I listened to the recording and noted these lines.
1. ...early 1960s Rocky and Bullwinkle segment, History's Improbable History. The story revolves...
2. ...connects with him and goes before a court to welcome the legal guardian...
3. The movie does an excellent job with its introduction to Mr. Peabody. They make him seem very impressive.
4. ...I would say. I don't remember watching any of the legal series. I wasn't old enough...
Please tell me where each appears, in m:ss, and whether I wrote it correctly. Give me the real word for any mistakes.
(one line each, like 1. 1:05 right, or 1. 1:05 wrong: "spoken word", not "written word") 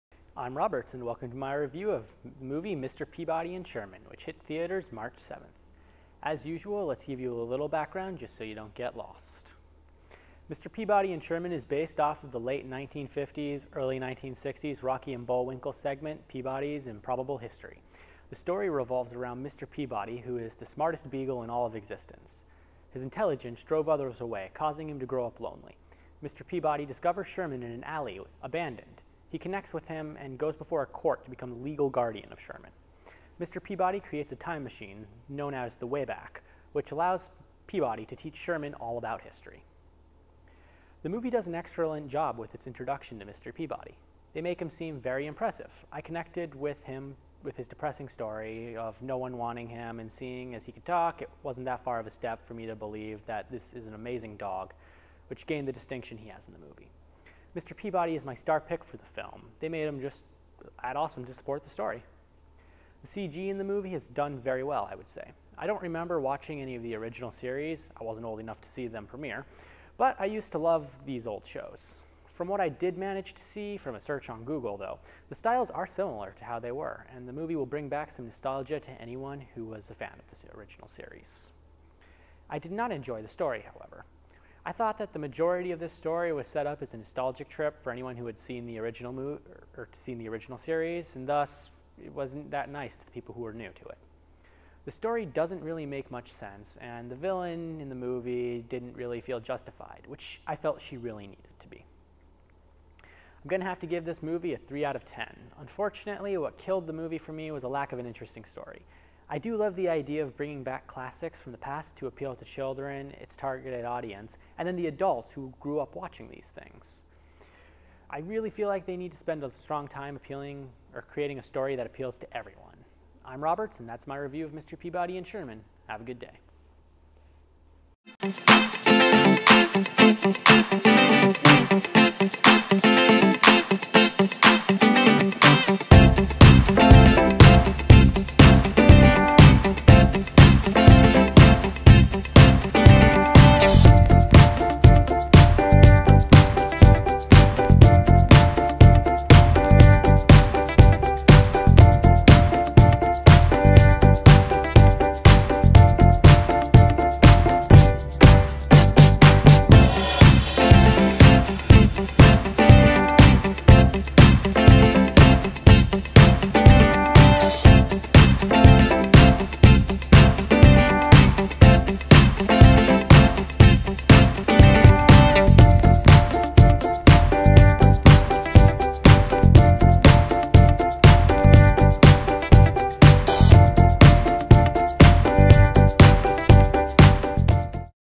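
1. 0:13 wrong: "Peabody", not "History"
2. 0:29 wrong: "become", not "welcome"
3. 0:41 right
4. 1:04 wrong: "original", not "legal".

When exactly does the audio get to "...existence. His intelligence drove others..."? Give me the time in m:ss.
0:21.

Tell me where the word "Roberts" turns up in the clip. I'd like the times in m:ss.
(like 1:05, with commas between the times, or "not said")
0:00, 2:03.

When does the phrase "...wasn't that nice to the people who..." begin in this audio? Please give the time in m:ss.
1:32.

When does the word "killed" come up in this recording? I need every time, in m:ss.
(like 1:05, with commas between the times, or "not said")
1:46.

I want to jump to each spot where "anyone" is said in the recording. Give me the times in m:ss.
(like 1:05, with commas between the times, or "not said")
1:19, 1:27.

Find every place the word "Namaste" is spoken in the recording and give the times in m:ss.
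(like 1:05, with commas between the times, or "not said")
not said.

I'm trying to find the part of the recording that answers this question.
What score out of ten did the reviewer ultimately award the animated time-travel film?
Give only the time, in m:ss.
1:44.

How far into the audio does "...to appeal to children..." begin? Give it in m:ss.
1:51.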